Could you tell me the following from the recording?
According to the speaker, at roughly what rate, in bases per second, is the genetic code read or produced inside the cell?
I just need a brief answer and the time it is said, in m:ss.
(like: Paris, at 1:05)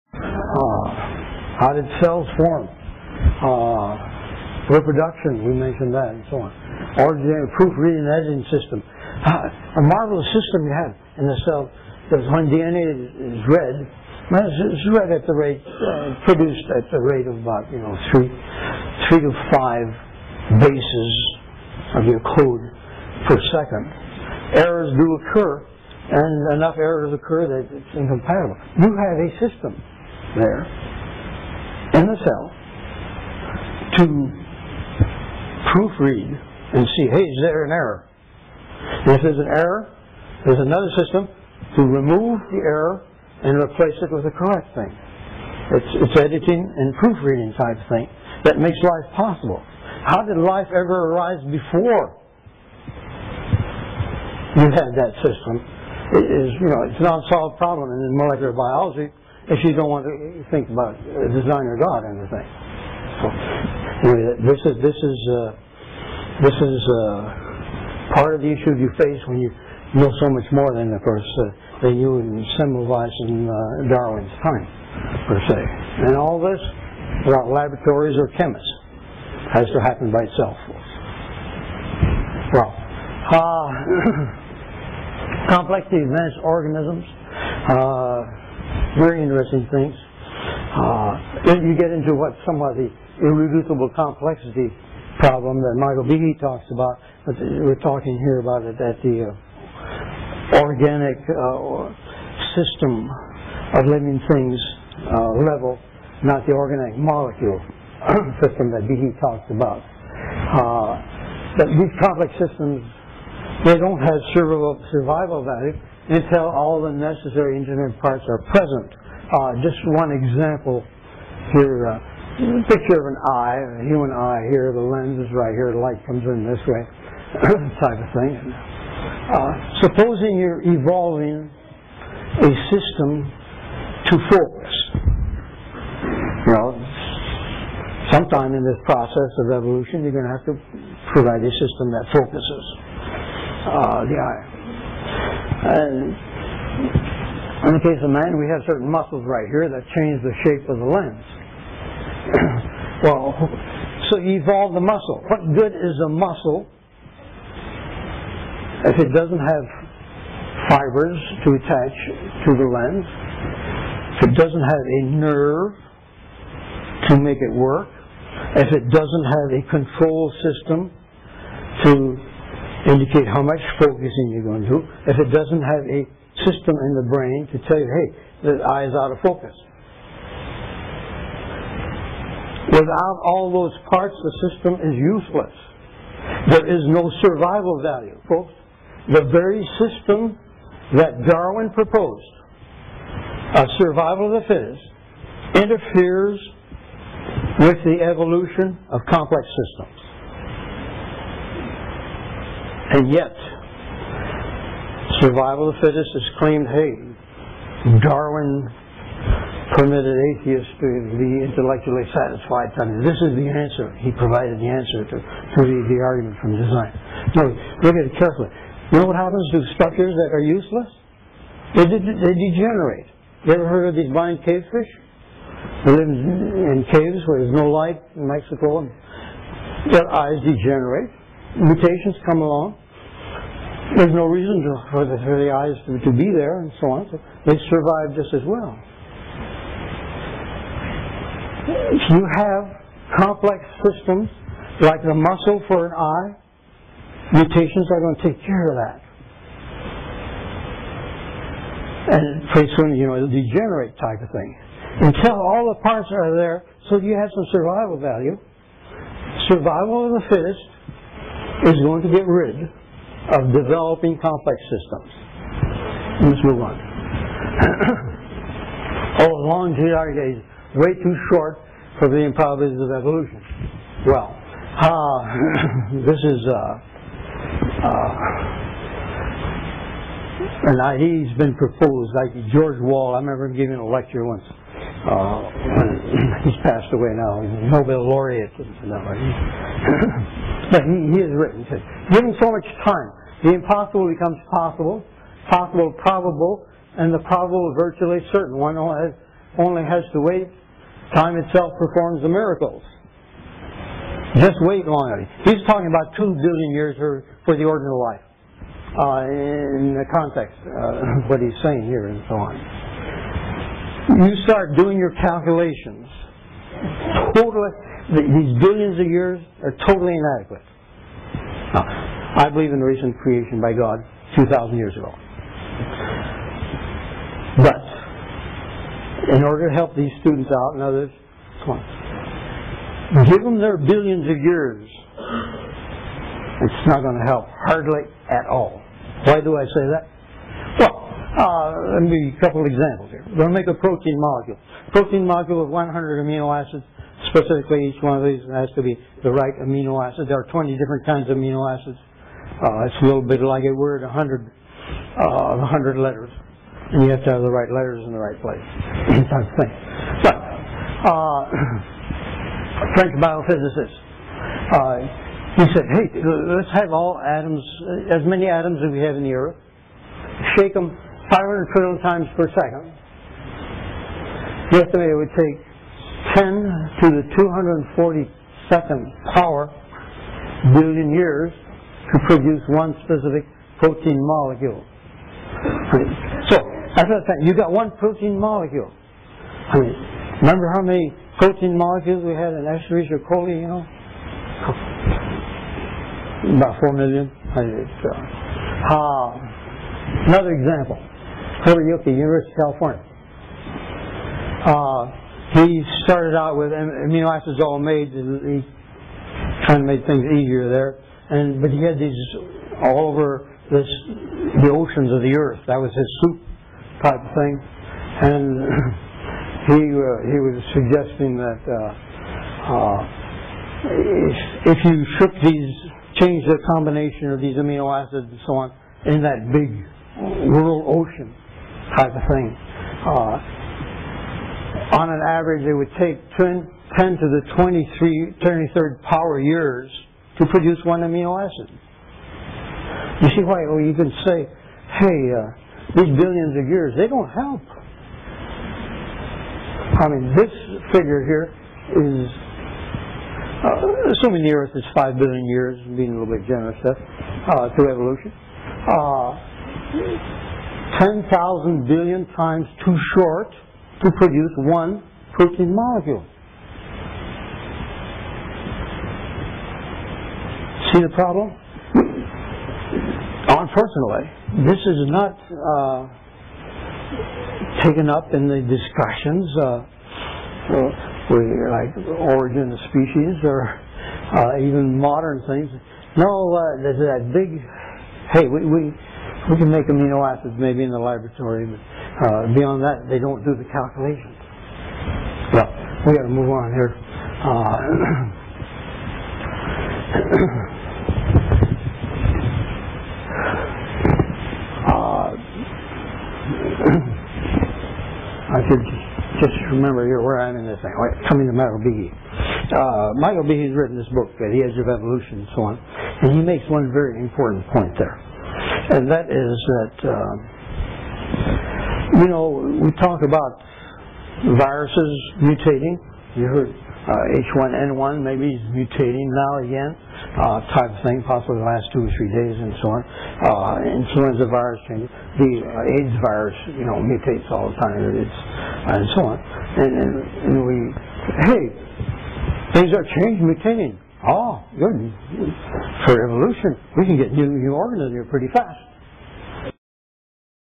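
3 to 5, at 0:19.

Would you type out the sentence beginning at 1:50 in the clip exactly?
Uh, but these complex systems, they don't have survival value until all the necessary engineering parts are present.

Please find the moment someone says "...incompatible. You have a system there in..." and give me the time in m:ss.
0:27.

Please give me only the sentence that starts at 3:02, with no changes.
Without all those parts, the system is useless.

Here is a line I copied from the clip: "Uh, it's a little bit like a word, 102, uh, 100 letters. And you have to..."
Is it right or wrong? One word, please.
wrong.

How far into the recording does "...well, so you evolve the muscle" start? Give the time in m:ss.
2:33.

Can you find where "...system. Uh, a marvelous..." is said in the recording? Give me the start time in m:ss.
0:08.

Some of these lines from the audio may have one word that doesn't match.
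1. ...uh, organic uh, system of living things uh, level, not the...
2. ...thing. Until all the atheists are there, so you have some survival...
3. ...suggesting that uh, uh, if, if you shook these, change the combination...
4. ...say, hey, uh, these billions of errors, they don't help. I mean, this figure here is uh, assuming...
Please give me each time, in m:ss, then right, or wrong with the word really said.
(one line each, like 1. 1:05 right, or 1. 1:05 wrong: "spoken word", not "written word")
1. 1:39 right
2. 4:14 wrong: "parts", not "atheists"
3. 7:00 right
4. 7:24 wrong: "years", not "errors".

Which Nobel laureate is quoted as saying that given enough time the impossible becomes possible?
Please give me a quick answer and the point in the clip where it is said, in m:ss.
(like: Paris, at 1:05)
George Wall, at 4:42.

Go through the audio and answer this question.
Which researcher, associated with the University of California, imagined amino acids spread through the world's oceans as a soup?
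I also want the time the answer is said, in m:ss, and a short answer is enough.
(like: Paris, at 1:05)
Herbert Yoki, at 6:41.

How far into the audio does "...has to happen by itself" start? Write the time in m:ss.
1:19.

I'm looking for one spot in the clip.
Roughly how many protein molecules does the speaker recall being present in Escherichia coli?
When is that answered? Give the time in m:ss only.
6:36.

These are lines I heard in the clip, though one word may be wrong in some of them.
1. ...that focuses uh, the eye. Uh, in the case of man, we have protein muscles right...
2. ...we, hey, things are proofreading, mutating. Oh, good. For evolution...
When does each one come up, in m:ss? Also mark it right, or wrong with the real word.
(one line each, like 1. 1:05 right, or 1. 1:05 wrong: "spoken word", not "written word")
1. 2:21 wrong: "certain", not "protein"
2. 9:00 wrong: "changing", not "proofreading".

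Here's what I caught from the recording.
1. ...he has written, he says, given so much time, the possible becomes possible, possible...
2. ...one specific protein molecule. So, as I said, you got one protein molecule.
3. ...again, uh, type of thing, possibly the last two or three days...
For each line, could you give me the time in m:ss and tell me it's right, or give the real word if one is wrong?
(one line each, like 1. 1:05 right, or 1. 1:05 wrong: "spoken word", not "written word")
1. 4:51 wrong: "impossible", not "possible"
2. 6:22 right
3. 8:49 right.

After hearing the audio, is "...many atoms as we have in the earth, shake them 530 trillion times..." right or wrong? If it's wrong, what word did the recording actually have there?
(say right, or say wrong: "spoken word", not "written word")
wrong: "500", not "530".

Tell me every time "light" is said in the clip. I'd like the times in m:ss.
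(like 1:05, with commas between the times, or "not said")
2:05, 3:47.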